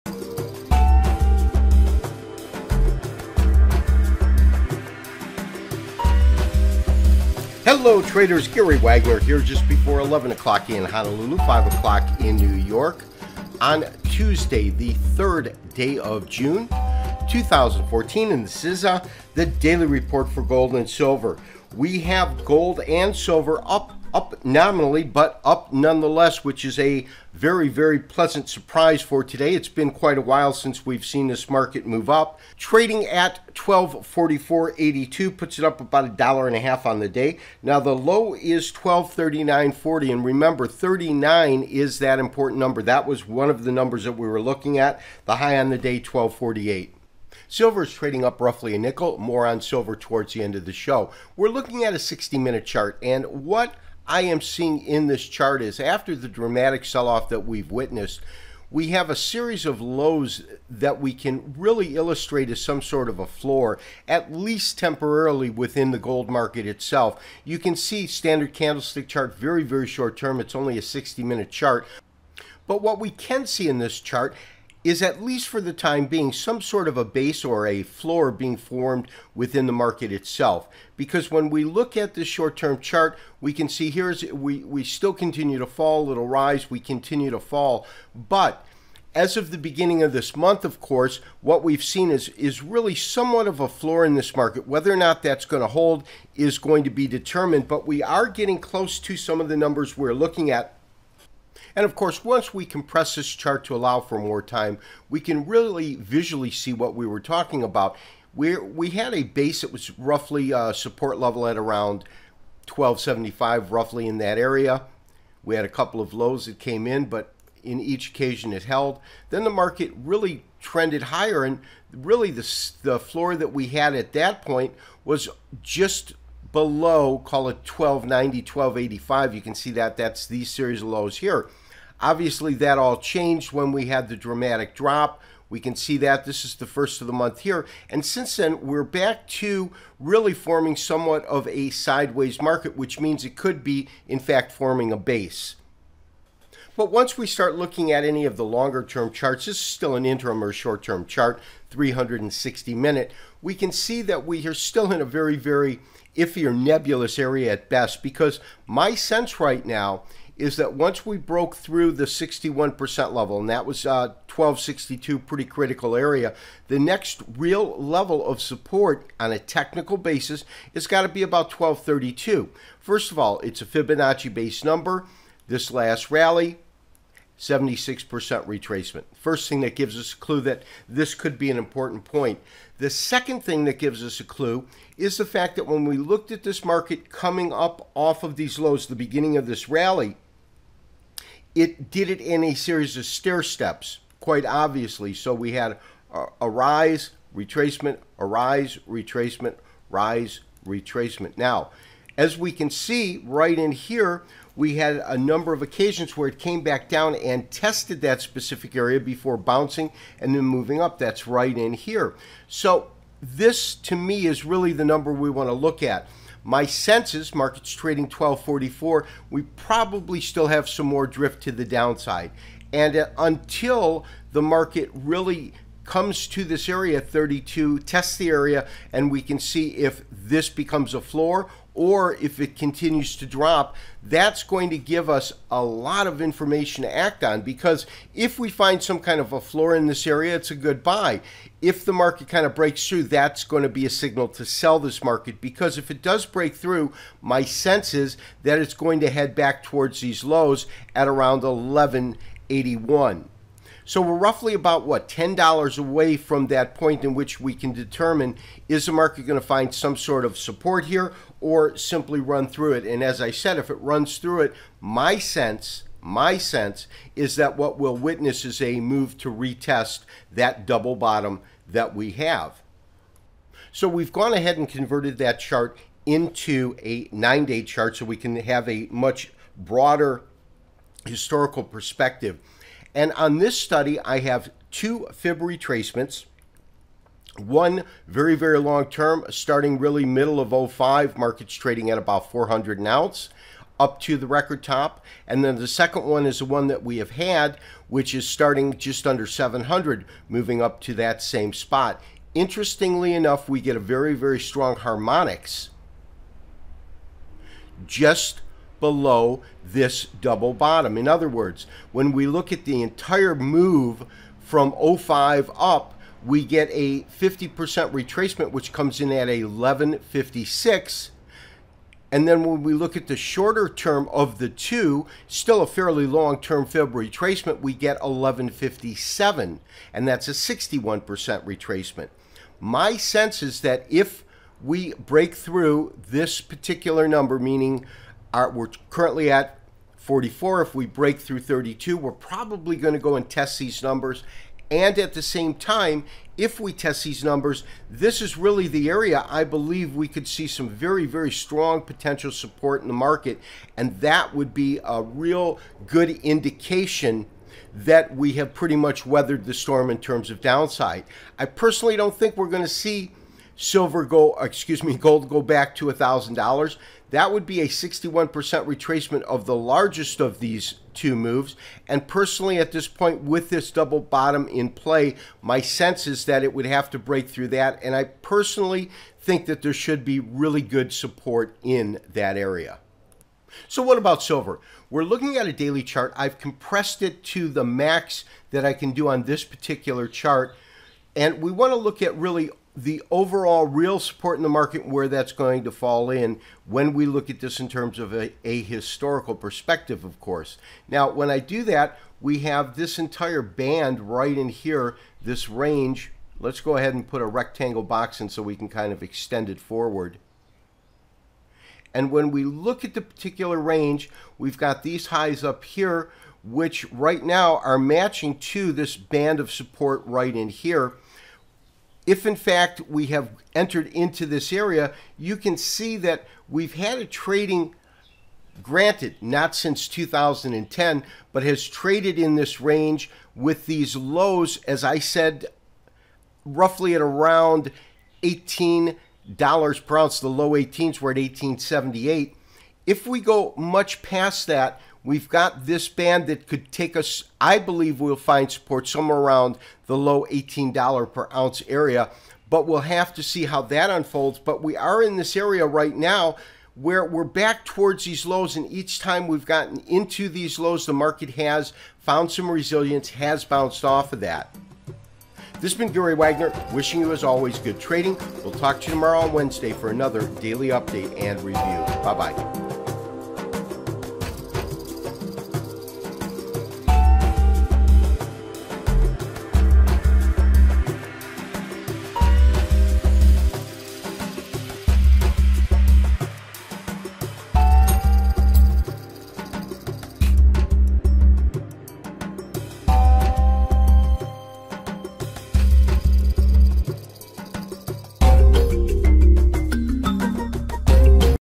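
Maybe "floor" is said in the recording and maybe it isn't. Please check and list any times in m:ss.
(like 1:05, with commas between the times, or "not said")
1:03, 1:17, 1:33, 2:02, 3:51, 3:59.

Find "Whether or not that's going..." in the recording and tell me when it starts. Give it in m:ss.
1:34.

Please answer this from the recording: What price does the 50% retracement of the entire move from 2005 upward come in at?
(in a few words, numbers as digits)
1156.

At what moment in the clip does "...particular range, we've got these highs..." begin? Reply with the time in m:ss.
6:53.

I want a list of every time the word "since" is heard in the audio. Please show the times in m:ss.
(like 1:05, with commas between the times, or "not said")
0:30, 2:18, 7:09.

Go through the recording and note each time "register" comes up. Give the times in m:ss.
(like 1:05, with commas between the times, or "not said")
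not said.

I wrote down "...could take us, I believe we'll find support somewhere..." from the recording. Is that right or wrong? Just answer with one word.
right.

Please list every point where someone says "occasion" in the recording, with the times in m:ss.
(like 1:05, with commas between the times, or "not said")
1:58, 3:25.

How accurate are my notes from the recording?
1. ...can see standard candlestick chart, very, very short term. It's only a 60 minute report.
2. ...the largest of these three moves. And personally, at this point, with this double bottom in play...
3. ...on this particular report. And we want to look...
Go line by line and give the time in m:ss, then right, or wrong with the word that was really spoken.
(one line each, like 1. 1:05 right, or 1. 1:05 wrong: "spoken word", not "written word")
1. 1:07 wrong: "chart", not "report"
2. 6:09 wrong: "two", not "three"
3. 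6:29 wrong: "chart", not "report".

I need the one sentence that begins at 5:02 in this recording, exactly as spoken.
Interestingly enough, we get a very, very strong harmonics just below this double bottom.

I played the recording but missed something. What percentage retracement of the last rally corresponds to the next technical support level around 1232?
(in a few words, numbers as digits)
76%.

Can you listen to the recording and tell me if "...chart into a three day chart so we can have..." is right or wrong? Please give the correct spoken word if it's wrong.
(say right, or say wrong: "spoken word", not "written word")
wrong: "nine", not "three".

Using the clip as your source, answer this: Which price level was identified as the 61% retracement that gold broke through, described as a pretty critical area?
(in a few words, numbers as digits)
1262.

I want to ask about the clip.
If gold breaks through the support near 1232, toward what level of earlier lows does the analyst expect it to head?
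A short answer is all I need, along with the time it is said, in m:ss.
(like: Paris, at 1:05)
1181, at 4:11.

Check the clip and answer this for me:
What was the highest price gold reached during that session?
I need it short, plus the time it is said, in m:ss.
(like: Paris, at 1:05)
1248, at 0:45.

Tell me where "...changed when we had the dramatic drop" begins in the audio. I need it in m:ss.
2:12.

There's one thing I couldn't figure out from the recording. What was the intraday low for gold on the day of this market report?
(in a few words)
1239.40.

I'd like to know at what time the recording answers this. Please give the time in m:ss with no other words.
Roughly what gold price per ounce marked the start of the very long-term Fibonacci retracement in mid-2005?
4:52.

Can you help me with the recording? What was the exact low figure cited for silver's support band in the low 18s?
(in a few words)
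18.78.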